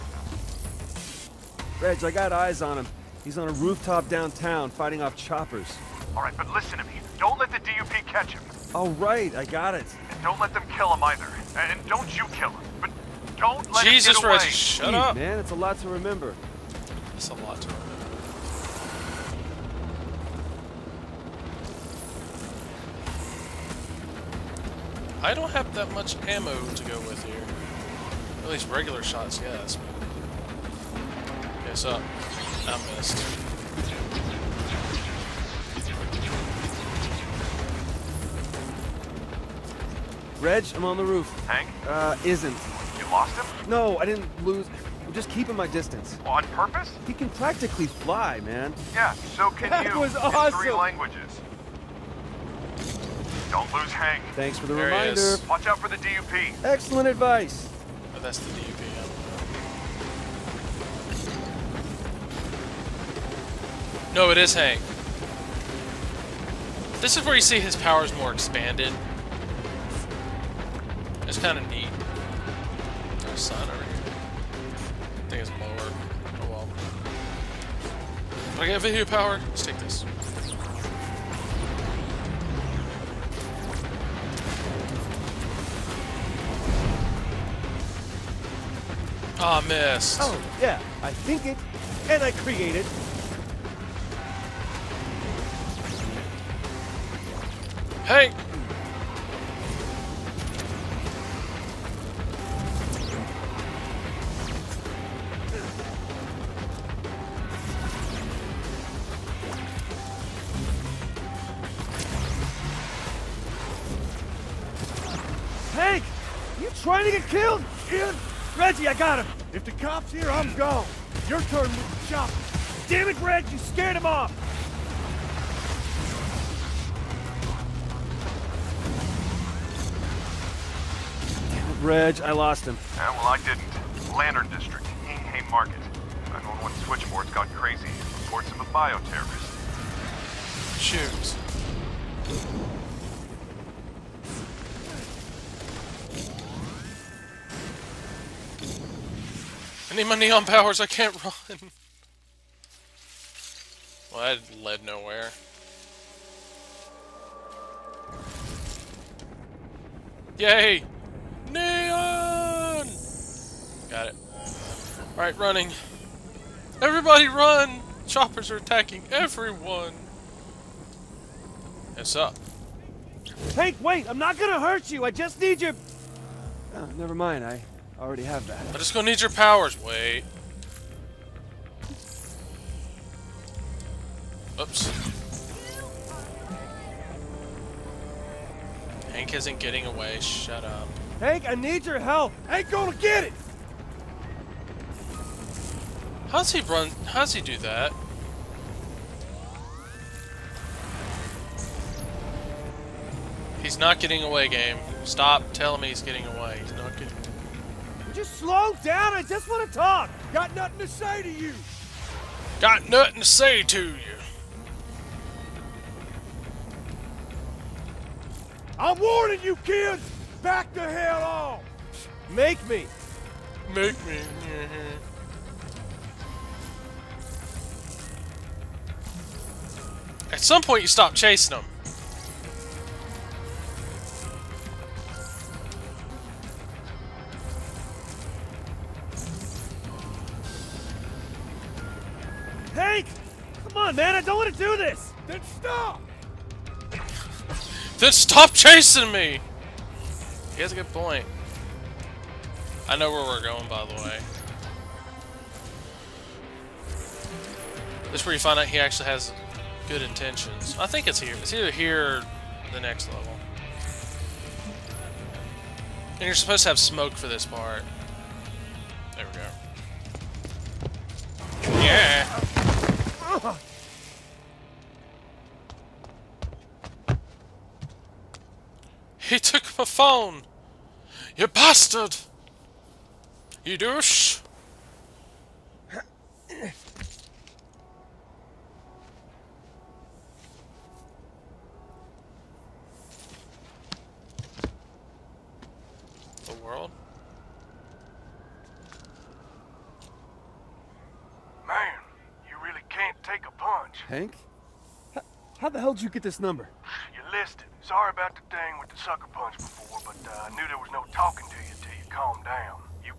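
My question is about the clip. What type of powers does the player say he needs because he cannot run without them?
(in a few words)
Neon powers.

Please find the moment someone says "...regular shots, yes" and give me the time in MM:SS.
00:28.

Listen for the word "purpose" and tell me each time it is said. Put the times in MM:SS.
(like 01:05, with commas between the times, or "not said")
00:46.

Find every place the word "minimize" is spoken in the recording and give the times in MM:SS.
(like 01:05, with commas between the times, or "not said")
not said.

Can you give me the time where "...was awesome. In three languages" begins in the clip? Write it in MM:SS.
00:49.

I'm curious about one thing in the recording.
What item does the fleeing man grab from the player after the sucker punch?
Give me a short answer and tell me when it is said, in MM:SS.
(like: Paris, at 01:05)
Phone, at 04:39.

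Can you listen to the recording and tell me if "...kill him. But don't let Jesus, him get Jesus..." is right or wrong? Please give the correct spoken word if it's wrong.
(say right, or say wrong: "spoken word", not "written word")
right.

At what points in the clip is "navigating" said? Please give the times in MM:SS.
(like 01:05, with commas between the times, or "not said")
not said.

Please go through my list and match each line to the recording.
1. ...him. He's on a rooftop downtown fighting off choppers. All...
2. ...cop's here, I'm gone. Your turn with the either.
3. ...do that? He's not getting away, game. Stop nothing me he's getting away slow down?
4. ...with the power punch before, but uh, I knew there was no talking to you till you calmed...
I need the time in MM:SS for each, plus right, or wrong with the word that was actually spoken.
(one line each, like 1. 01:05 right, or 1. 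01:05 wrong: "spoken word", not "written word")
1. 00:02 right
2. 01:59 wrong: "chopper", not "either"
3. 03:17 wrong: "telling", not "nothing"
4. 05:08 wrong: "sucker", not "power".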